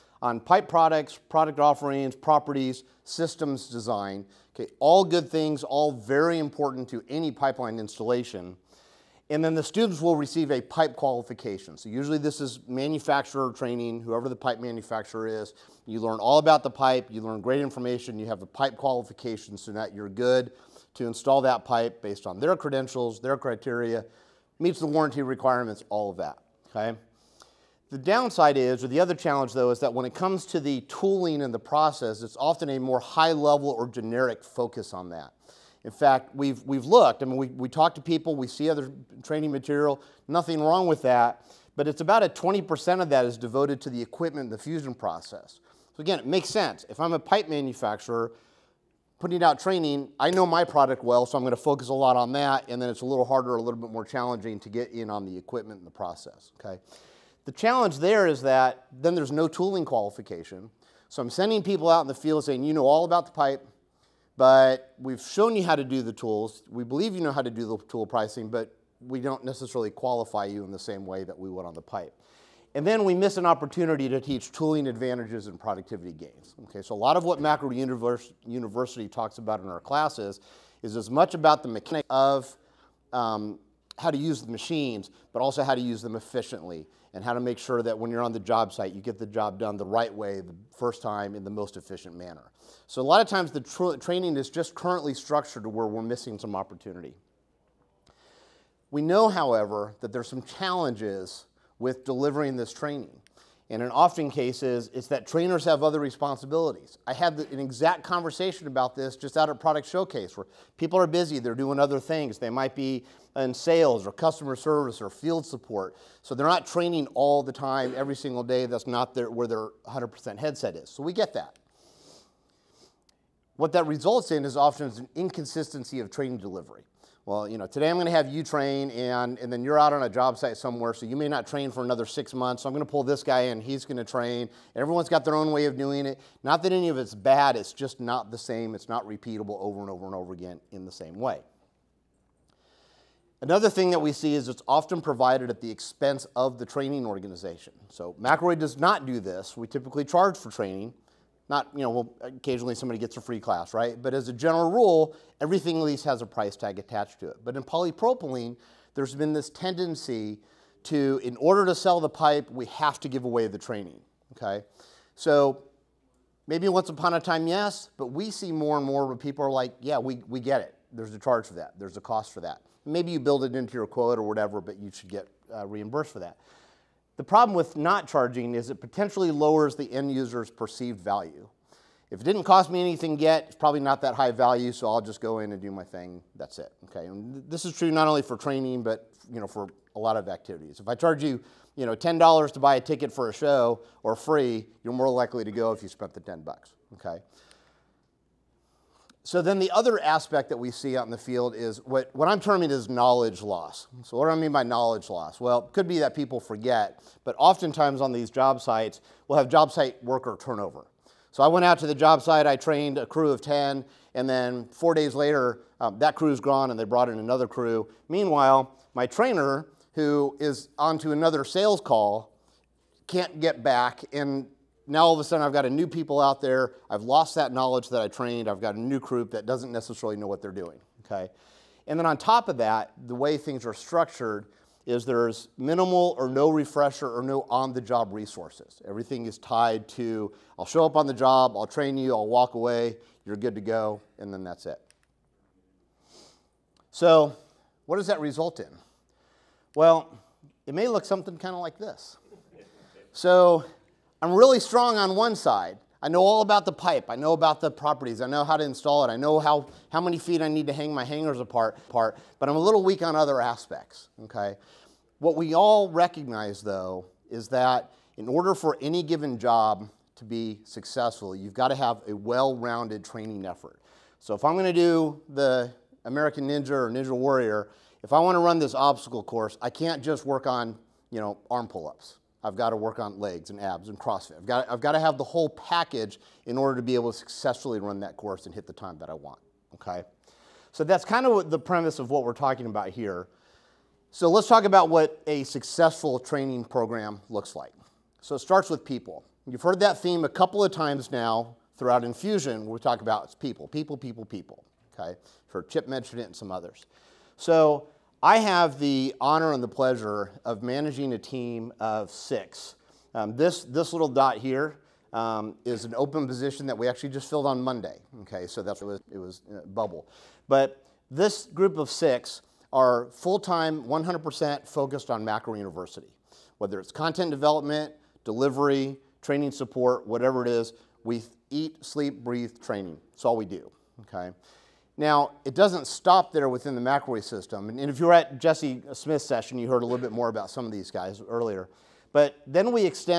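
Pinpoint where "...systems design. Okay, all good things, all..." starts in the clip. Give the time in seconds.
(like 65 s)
3 s.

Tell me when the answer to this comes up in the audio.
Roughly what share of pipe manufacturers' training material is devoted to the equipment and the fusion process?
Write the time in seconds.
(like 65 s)
42 s.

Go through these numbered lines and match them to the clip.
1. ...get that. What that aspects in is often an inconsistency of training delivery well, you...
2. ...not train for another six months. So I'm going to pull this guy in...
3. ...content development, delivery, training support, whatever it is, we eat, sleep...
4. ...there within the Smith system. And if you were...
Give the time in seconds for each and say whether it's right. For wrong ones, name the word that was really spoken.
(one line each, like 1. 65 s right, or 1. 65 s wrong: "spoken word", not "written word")
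1. 121 s wrong: "results", not "aspects"
2. 131 s right
3. 326 s right
4. 336 s wrong: "McElroy", not "Smith".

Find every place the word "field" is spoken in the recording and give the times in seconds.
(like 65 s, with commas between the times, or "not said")
62 s, 115 s, 201 s.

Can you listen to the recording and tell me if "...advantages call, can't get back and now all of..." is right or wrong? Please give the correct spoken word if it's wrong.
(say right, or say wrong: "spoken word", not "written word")
wrong: "sales", not "advantages".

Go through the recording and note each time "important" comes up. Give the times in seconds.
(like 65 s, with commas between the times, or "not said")
6 s.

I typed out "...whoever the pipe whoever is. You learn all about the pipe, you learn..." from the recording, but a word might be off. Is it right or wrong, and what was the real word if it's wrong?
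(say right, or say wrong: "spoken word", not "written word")
wrong: "manufacturer", not "whoever".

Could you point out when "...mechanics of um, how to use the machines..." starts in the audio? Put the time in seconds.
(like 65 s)
81 s.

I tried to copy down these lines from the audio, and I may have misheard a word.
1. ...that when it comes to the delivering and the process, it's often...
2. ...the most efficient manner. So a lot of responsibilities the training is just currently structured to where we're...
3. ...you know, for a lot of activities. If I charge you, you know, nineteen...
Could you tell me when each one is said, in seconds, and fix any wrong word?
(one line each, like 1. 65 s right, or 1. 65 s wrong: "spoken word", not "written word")
1. 29 s wrong: "tooling", not "delivering"
2. 91 s wrong: "times", not "responsibilities"
3. 189 s wrong: "ten", not "nineteen".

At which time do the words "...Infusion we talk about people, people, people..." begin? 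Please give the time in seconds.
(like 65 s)
302 s.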